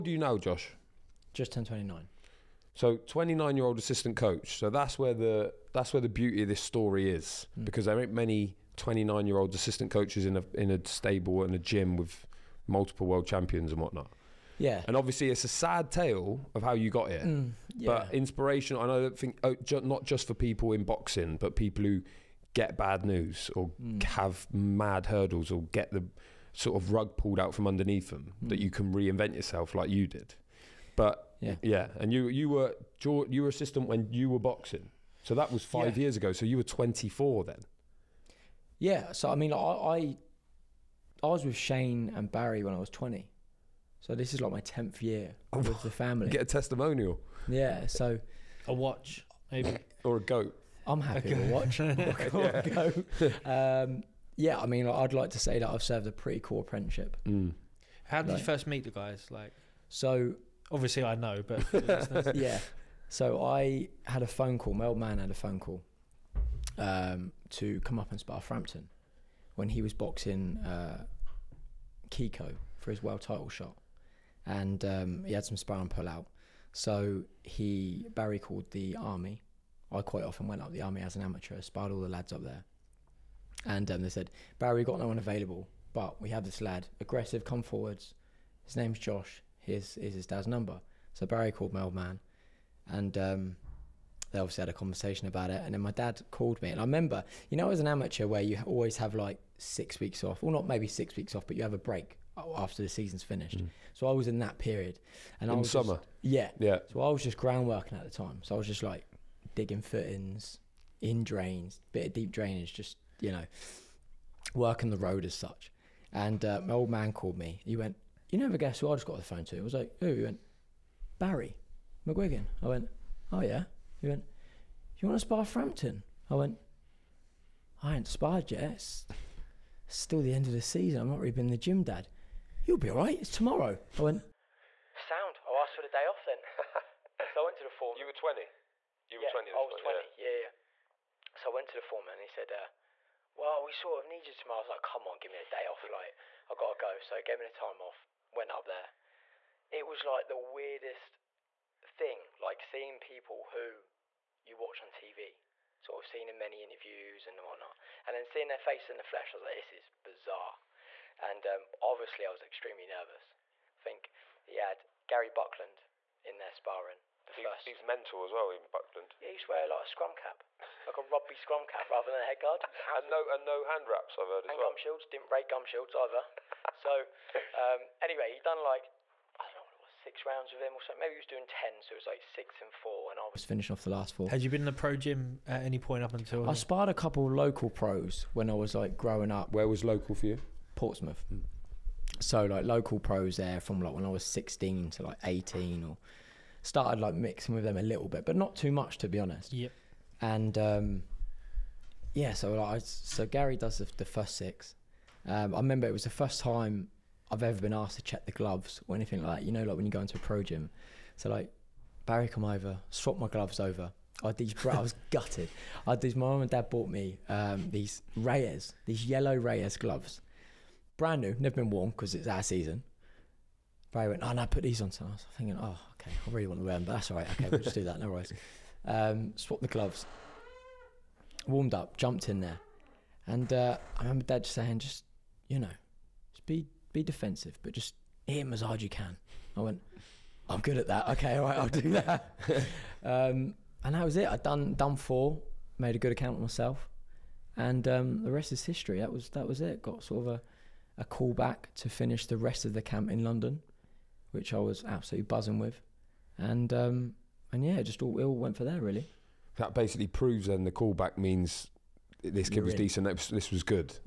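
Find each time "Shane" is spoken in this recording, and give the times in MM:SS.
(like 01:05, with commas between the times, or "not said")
00:41.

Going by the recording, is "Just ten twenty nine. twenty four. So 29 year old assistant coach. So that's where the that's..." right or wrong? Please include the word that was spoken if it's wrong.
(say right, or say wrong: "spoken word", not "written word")
wrong: "nine", not "four".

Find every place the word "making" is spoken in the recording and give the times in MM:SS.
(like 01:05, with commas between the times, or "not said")
not said.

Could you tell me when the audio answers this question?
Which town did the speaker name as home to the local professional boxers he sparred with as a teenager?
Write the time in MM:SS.
03:10.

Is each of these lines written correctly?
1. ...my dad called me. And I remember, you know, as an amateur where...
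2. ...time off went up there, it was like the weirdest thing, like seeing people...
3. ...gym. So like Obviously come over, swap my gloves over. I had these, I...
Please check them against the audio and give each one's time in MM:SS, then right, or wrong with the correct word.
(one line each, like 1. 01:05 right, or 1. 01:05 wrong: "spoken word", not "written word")
1. 01:35 right
2. 02:27 right
3. 03:30 wrong: "Barry", not "Obviously".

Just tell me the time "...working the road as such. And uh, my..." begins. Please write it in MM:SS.
01:54.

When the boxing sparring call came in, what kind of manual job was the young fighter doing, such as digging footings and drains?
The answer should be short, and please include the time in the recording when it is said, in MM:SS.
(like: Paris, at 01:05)
Groundworking, at 01:47.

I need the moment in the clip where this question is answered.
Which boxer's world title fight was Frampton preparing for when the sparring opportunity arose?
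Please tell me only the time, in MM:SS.
01:12.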